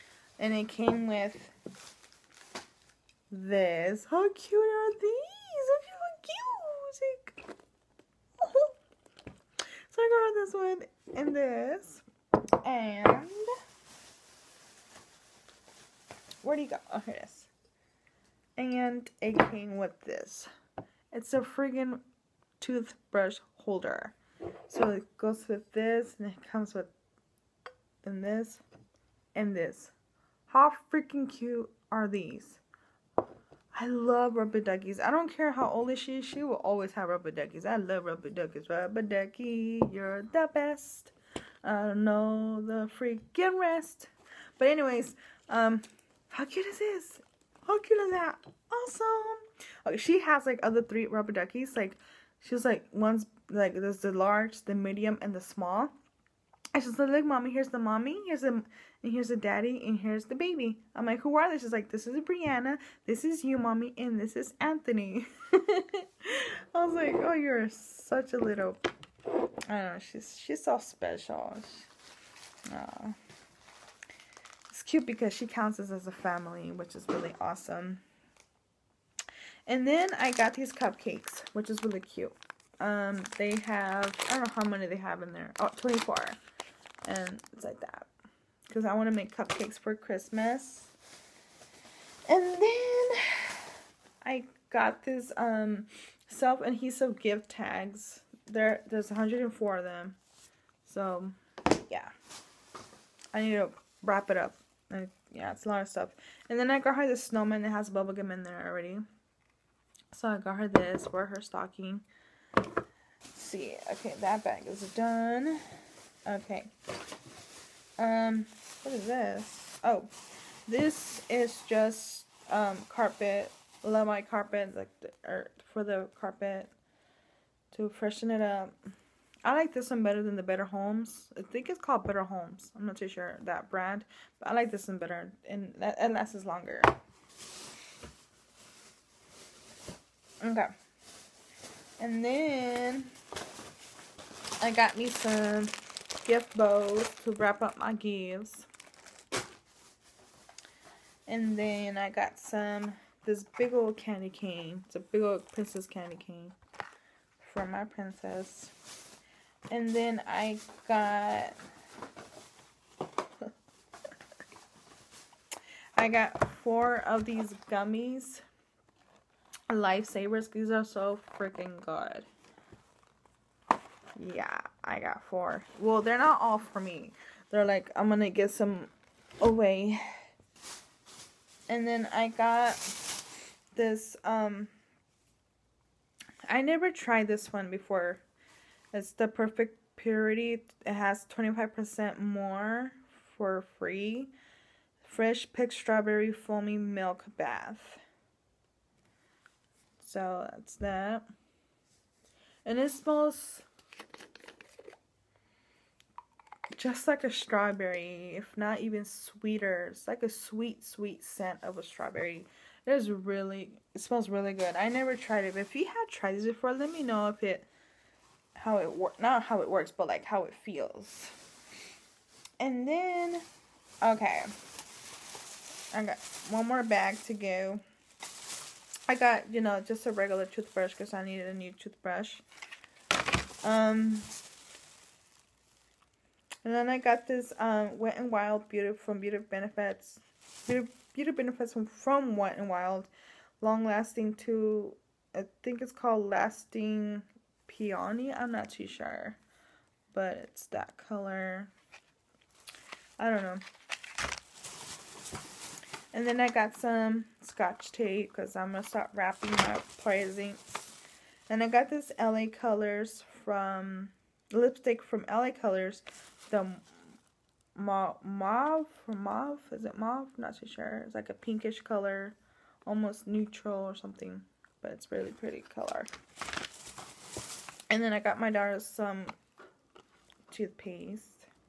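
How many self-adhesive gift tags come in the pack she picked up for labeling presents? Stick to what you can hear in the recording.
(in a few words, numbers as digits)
104.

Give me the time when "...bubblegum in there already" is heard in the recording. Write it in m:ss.
1:47.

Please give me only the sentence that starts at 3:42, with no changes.
And then, okay, I got one more bag to go.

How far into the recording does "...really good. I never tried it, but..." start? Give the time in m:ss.
3:34.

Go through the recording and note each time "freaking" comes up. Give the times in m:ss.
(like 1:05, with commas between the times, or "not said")
0:30, 0:42, 2:51.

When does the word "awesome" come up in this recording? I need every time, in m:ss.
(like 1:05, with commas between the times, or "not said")
0:48, 1:17.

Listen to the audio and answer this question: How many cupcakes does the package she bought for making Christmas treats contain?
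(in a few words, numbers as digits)
24.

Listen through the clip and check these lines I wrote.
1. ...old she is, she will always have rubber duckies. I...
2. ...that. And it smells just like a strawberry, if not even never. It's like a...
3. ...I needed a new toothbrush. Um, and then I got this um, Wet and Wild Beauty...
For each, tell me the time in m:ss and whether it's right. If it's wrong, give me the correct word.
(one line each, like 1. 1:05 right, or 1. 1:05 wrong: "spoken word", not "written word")
1. 0:35 right
2. 3:20 wrong: "sweeter", not "never"
3. 3:51 right.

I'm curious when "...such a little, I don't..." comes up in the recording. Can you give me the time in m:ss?
1:07.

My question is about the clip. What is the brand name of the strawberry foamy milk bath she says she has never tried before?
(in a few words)
Perfect Purity.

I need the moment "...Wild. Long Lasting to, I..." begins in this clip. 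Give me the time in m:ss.
4:02.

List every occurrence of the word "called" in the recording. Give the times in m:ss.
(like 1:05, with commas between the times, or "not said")
2:11, 4:05.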